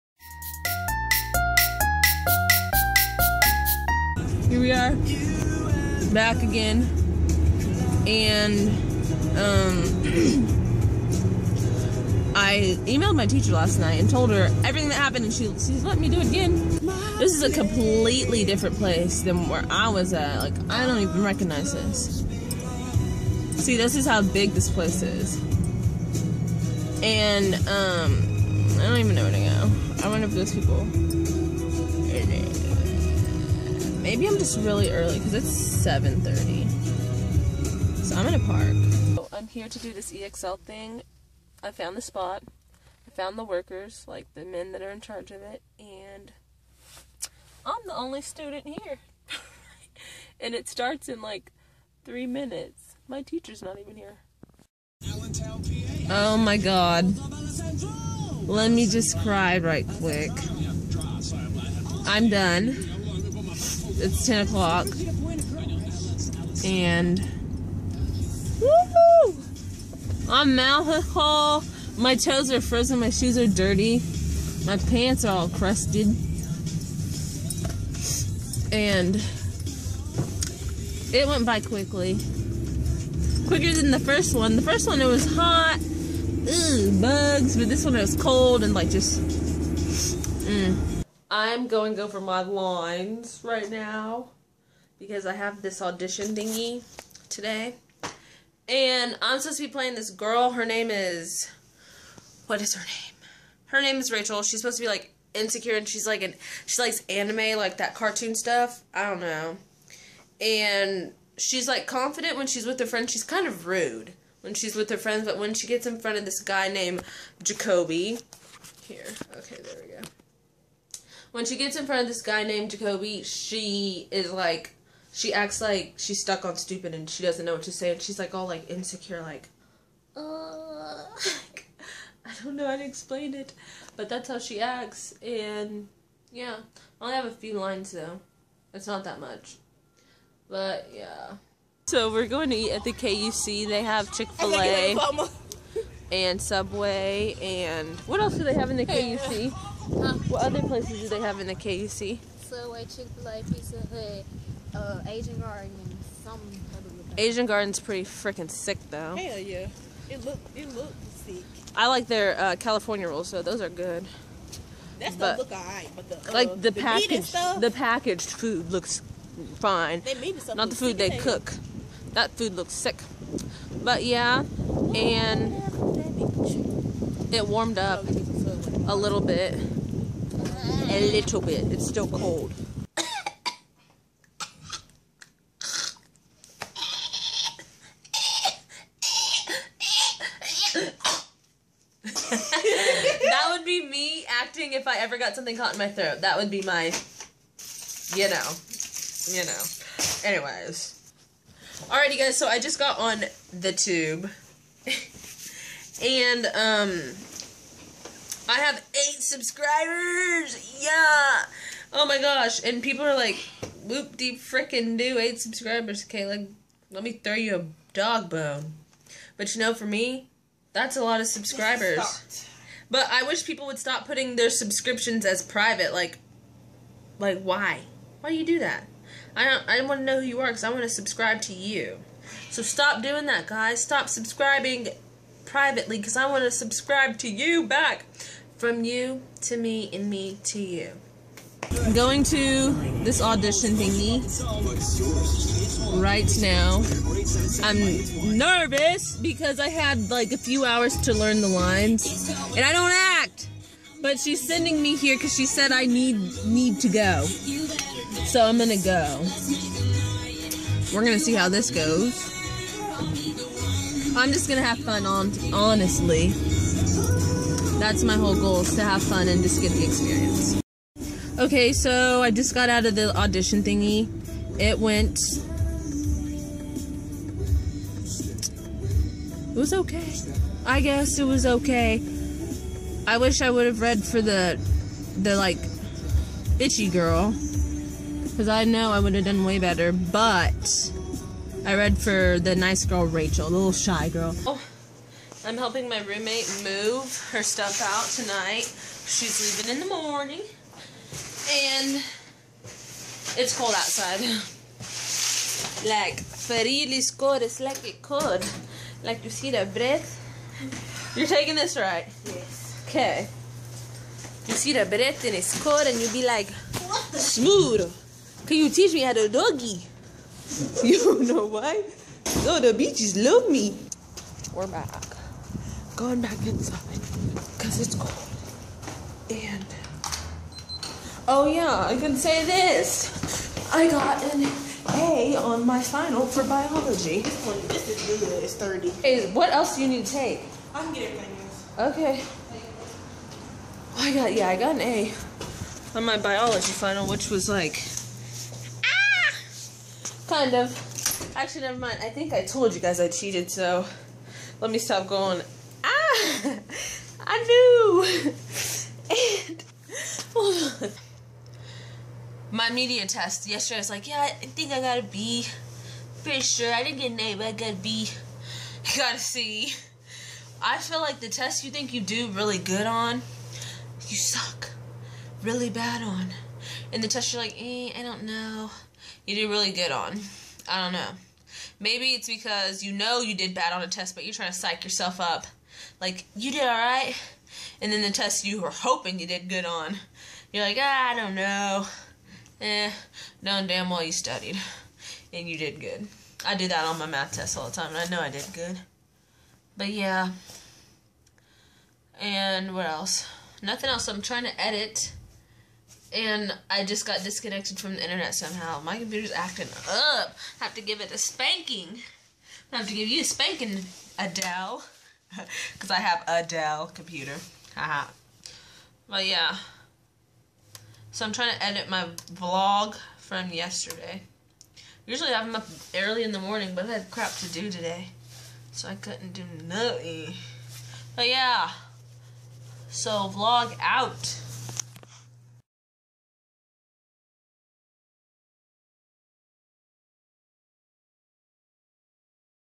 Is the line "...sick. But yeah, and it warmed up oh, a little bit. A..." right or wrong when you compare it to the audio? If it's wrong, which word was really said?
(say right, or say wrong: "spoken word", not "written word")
right.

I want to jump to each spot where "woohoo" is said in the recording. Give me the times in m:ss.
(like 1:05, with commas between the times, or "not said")
1:08.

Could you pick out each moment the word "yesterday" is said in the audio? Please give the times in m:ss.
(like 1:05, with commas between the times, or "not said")
6:03, 7:03.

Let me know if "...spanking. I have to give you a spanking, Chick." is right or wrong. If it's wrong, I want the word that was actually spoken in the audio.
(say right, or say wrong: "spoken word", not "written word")
wrong: "Adele", not "Chick".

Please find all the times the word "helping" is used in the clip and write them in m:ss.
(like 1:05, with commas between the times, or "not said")
4:55.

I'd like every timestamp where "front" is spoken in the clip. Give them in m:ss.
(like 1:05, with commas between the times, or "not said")
1:55, 2:01.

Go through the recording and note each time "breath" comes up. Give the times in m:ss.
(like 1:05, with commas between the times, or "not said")
5:09, 5:14.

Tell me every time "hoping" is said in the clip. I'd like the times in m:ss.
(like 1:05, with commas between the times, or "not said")
6:28.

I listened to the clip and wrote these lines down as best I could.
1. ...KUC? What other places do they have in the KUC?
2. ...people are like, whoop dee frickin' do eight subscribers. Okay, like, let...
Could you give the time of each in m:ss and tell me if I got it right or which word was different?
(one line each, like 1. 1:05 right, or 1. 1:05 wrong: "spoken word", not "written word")
1. 2:28 right
2. 3:32 right.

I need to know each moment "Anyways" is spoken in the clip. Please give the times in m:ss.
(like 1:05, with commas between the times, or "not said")
3:20.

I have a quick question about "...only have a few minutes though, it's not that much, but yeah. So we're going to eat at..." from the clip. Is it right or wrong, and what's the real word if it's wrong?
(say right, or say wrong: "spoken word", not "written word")
wrong: "lines", not "minutes".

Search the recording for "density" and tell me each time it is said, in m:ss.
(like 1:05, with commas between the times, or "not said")
not said.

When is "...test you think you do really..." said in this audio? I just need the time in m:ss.
6:11.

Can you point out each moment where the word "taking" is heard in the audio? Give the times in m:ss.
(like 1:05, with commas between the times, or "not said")
5:11.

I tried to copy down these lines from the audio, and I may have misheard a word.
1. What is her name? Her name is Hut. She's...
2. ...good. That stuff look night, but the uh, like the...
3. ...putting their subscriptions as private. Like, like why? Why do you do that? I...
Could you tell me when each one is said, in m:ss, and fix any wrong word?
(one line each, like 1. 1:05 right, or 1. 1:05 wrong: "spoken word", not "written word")
1. 1:42 wrong: "Rachel", not "Hut"
2. 2:43 wrong: "alright", not "night"
3. 3:44 right.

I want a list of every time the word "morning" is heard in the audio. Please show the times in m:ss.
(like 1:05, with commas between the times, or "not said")
4:59, 7:06.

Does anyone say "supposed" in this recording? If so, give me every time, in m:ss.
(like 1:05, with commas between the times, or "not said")
1:39, 1:44.